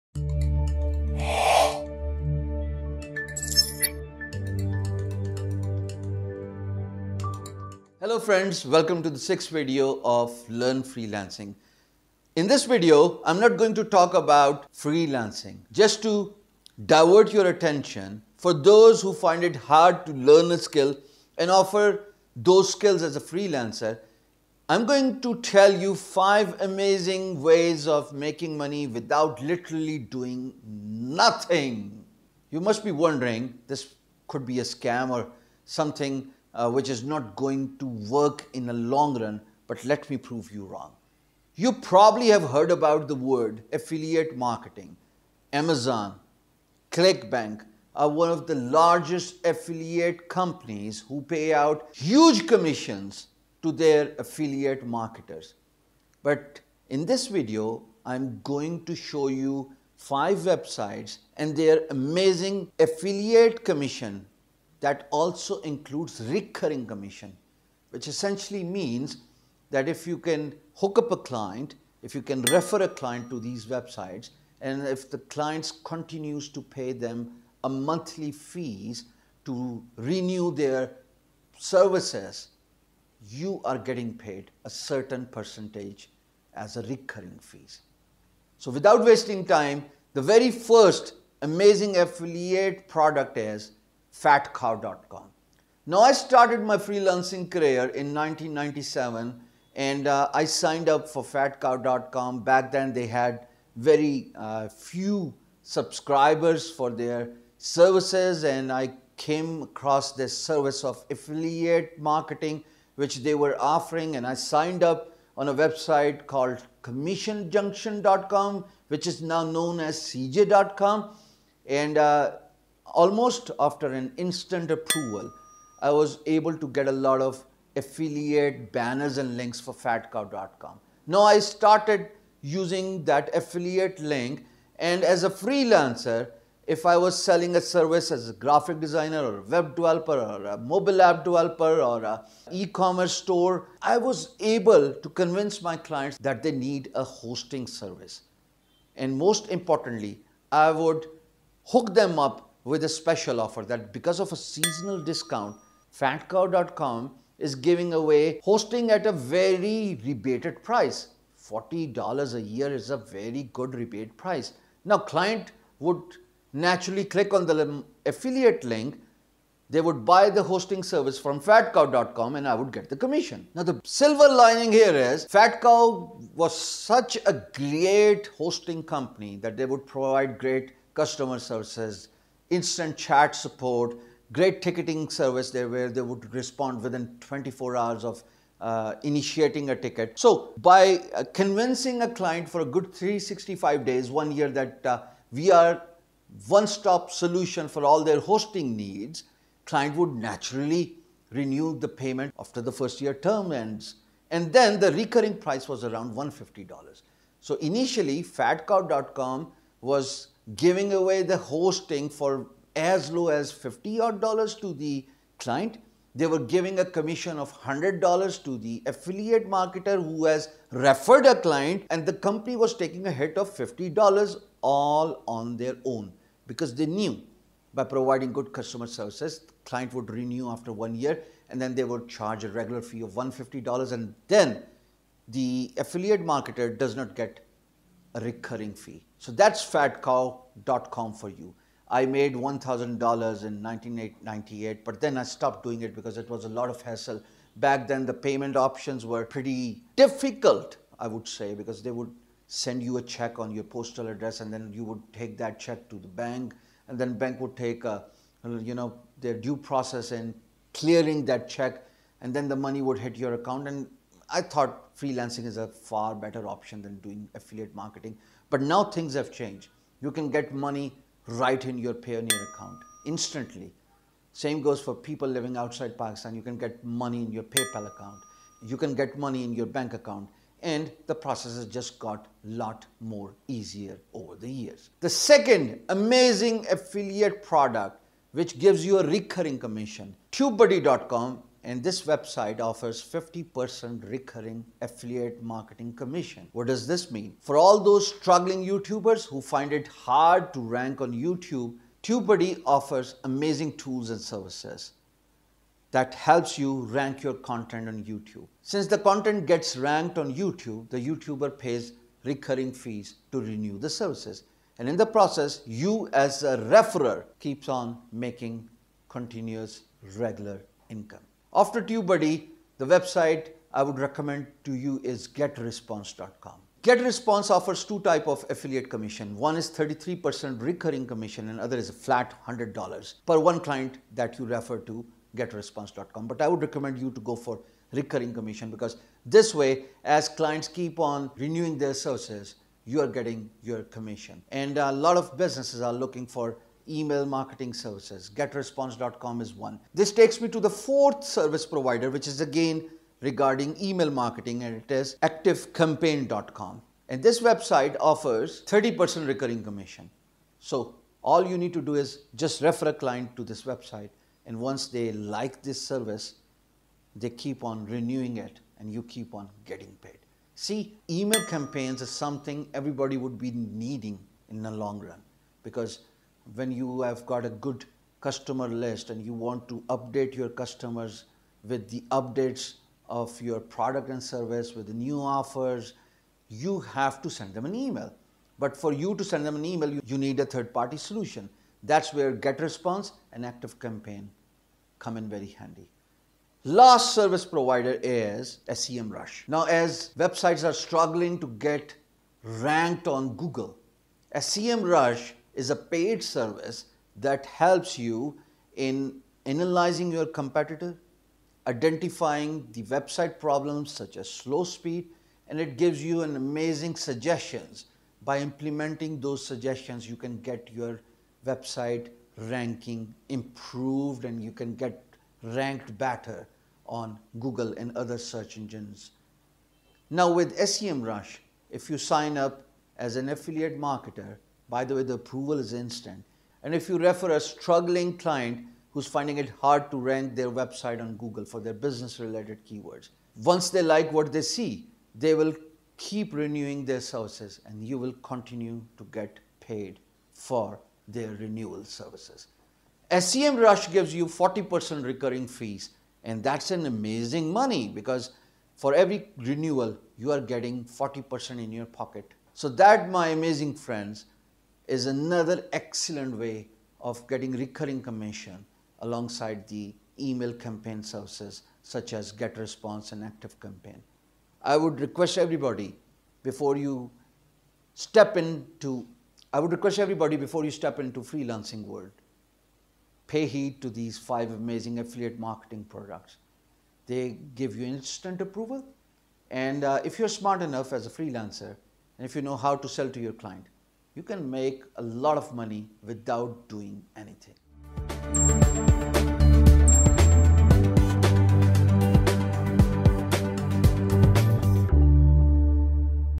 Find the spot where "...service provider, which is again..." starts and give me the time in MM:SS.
05:51.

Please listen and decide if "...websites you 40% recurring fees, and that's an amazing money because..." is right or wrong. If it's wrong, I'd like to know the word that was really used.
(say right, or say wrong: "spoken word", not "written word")
wrong: "gives", not "websites".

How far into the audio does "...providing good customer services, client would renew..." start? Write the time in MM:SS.
03:47.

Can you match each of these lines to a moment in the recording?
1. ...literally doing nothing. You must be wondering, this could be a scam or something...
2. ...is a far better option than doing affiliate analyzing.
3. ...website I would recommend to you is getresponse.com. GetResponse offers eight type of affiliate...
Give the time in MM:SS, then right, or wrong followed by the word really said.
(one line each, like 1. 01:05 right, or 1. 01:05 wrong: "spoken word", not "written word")
1. 00:29 right
2. 04:25 wrong: "marketing", not "analyzing"
3. 05:22 wrong: "two", not "eight".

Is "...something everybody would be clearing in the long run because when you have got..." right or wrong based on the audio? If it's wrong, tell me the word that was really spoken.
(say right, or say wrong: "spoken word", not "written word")
wrong: "needing", not "clearing".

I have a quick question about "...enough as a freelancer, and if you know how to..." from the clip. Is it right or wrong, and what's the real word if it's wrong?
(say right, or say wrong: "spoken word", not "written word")
right.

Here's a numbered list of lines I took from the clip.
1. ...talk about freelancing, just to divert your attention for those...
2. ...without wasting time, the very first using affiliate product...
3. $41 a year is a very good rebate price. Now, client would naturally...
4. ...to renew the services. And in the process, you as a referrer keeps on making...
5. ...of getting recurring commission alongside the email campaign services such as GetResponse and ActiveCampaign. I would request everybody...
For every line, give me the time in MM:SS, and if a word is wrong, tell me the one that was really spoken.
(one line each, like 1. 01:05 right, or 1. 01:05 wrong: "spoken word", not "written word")
1. 00:13 right
2. 01:28 wrong: "amazing", not "using"
3. 02:41 wrong: "40", not "41"
4. 05:13 right
5. 07:47 right.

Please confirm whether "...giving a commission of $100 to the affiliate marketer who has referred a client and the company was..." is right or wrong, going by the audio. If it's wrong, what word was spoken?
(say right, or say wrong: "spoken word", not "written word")
right.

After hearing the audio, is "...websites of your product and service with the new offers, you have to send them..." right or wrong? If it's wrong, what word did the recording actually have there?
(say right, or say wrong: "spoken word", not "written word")
wrong: "updates", not "websites".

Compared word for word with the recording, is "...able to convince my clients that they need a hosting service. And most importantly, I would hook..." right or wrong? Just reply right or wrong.
right.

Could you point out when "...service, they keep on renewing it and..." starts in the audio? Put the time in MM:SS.
06:05.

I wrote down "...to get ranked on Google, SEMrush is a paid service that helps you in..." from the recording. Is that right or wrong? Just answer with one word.
right.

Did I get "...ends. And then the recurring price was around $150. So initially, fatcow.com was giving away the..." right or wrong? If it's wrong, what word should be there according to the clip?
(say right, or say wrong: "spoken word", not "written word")
right.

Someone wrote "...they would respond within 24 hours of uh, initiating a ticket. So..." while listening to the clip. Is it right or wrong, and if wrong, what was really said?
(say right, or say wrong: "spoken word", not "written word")
right.